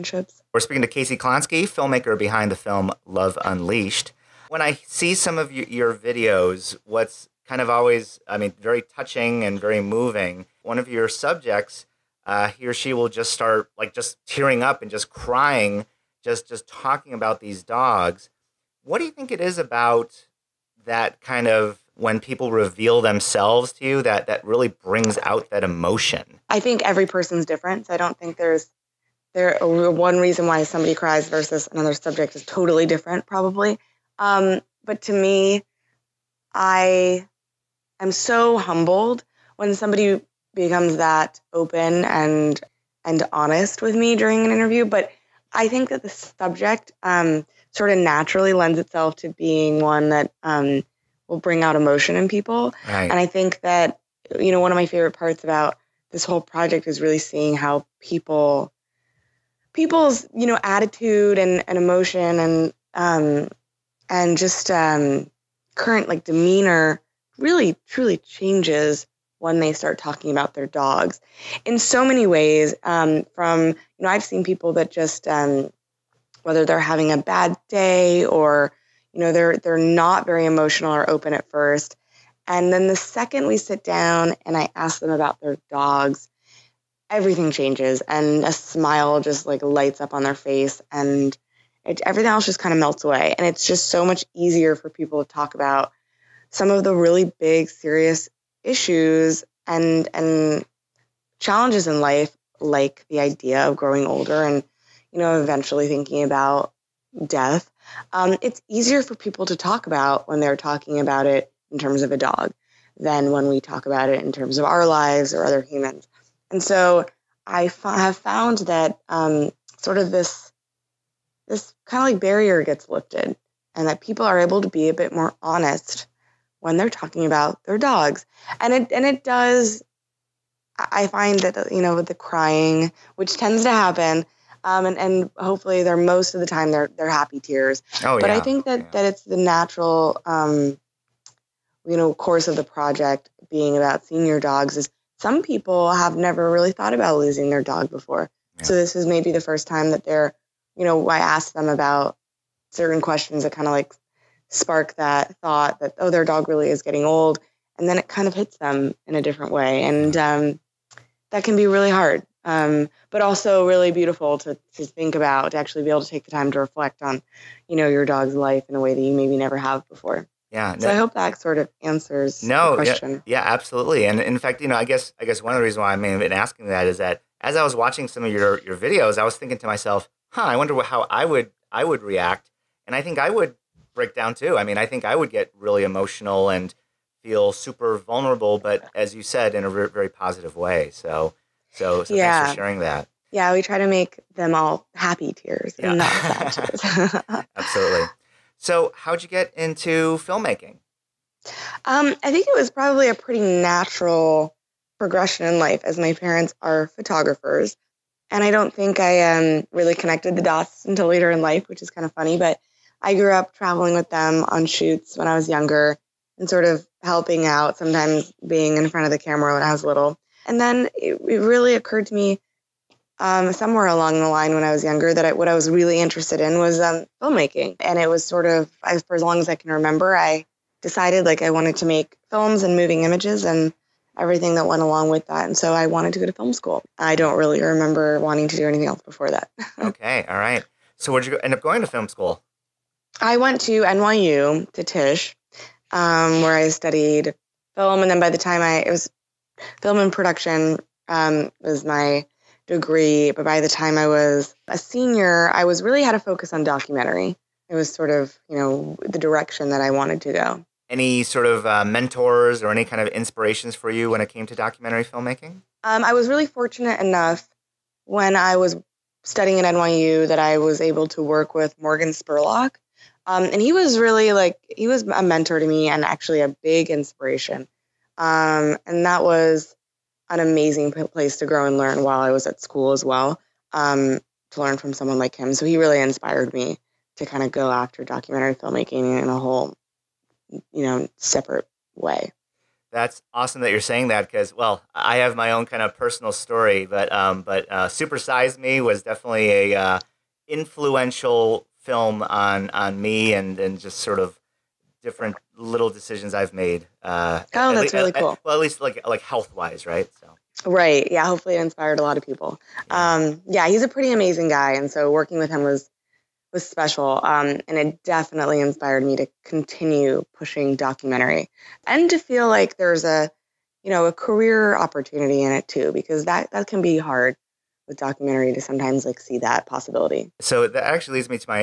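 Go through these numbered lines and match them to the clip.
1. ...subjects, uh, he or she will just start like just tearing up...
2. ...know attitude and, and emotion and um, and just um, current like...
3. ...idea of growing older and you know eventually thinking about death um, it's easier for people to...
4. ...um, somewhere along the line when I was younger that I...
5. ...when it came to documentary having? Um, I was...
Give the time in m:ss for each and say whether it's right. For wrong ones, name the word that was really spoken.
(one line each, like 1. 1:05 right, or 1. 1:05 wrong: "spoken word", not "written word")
1. 0:11 right
2. 1:00 right
3. 1:43 right
4. 3:43 right
5. 4:24 wrong: "filmmaking", not "having".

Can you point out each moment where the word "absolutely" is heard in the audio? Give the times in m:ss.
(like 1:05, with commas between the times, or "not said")
2:53, 3:17.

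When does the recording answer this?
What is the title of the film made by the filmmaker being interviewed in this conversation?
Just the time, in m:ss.
0:03.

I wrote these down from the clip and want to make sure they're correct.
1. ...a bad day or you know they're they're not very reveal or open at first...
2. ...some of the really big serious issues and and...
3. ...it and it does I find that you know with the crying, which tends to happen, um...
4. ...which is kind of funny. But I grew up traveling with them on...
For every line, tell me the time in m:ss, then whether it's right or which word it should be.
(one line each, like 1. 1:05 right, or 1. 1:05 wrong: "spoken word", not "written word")
1. 1:17 wrong: "emotional", not "reveal"
2. 1:36 right
3. 2:08 right
4. 3:31 right.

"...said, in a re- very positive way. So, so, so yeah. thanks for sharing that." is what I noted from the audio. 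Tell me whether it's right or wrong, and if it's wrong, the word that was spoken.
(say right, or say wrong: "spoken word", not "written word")
right.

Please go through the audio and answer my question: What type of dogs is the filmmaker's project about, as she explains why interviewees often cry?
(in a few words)
Senior dogs.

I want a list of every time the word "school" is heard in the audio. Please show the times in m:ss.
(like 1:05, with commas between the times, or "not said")
3:56, 4:02, 4:42.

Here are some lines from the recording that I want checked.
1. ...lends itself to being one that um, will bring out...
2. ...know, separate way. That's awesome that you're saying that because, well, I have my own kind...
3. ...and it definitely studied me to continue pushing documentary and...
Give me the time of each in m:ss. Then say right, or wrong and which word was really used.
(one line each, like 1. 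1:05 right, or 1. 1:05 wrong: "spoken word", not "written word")
1. 0:48 right
2. 4:50 right
3. 5:17 wrong: "inspired", not "studied".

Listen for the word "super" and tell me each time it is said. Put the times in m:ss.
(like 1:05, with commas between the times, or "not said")
3:07, 4:57.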